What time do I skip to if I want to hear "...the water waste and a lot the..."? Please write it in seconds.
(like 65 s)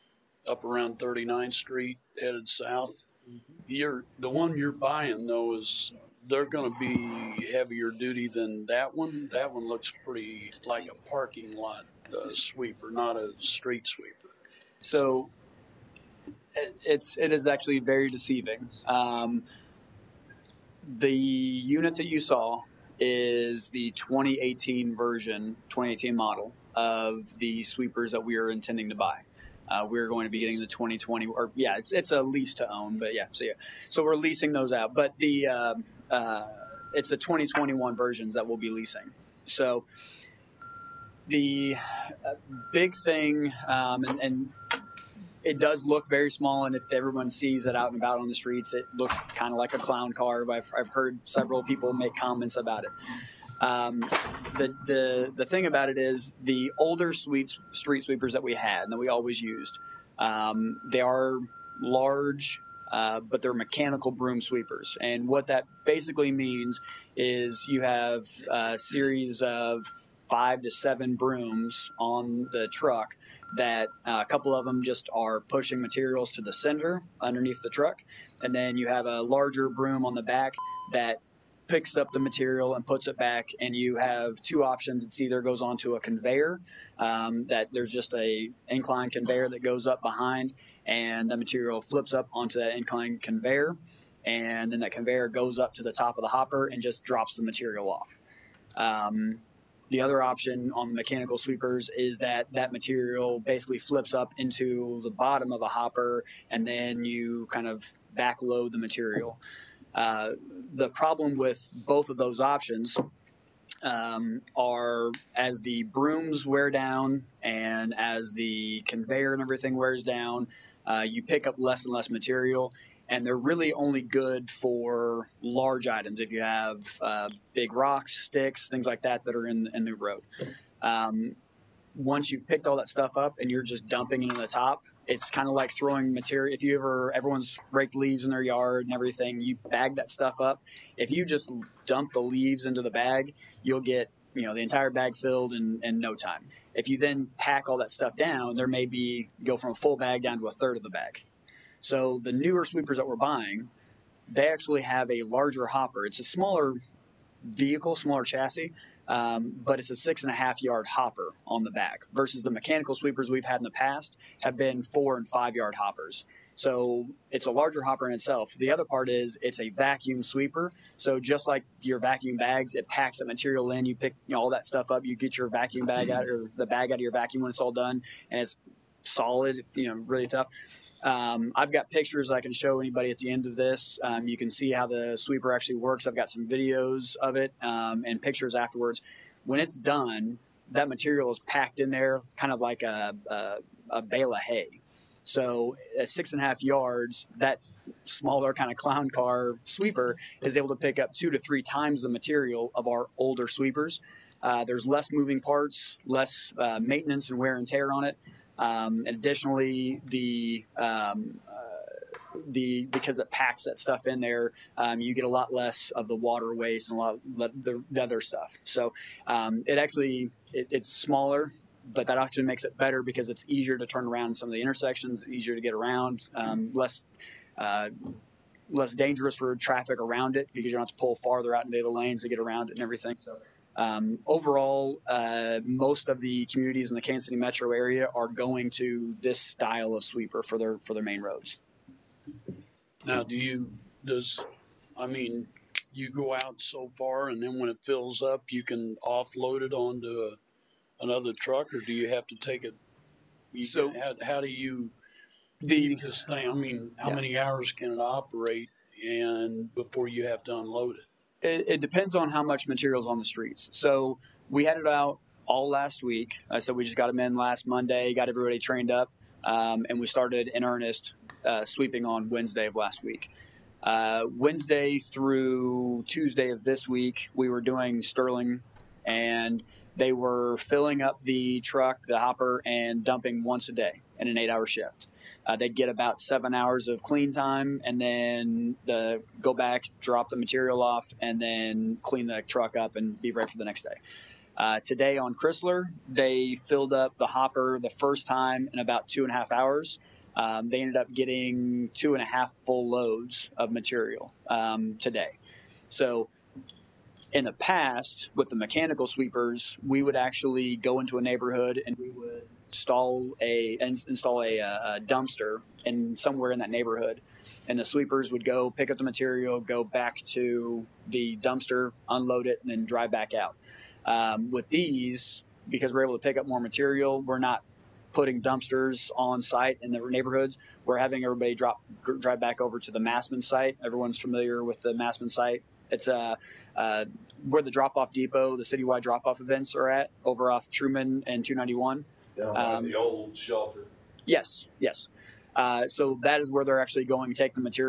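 216 s.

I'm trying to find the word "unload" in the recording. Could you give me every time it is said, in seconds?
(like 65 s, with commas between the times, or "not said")
260 s, 322 s.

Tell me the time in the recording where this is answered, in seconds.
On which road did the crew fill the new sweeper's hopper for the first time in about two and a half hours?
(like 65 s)
295 s.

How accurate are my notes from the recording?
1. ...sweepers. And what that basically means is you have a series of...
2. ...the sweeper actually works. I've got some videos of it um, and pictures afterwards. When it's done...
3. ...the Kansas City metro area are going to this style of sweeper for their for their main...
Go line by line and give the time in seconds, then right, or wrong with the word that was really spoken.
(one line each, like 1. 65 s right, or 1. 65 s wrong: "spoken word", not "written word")
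1. 64 s right
2. 184 s right
3. 236 s right.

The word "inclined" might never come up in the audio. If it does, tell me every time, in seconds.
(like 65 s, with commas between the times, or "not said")
88 s, 92 s.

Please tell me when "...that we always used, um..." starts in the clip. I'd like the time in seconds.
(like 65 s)
58 s.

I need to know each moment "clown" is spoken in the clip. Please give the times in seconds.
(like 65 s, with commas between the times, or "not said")
49 s, 198 s.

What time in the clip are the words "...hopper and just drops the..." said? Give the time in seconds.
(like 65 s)
96 s.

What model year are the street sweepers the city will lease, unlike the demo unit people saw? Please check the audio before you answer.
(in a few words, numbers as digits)
2021.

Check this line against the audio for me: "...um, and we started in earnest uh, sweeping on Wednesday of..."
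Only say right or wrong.
right.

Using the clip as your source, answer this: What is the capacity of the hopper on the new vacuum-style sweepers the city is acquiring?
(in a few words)
6.5 yards.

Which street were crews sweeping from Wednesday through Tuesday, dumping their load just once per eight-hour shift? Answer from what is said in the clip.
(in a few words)
Sterling.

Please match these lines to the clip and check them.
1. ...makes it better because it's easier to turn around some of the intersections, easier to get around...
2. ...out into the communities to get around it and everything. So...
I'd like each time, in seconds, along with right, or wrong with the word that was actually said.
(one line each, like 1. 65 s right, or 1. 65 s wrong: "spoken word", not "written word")
1. 222 s right
2. 231 s wrong: "lanes", not "communities".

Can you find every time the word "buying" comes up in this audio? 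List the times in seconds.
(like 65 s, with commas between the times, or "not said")
4 s, 153 s.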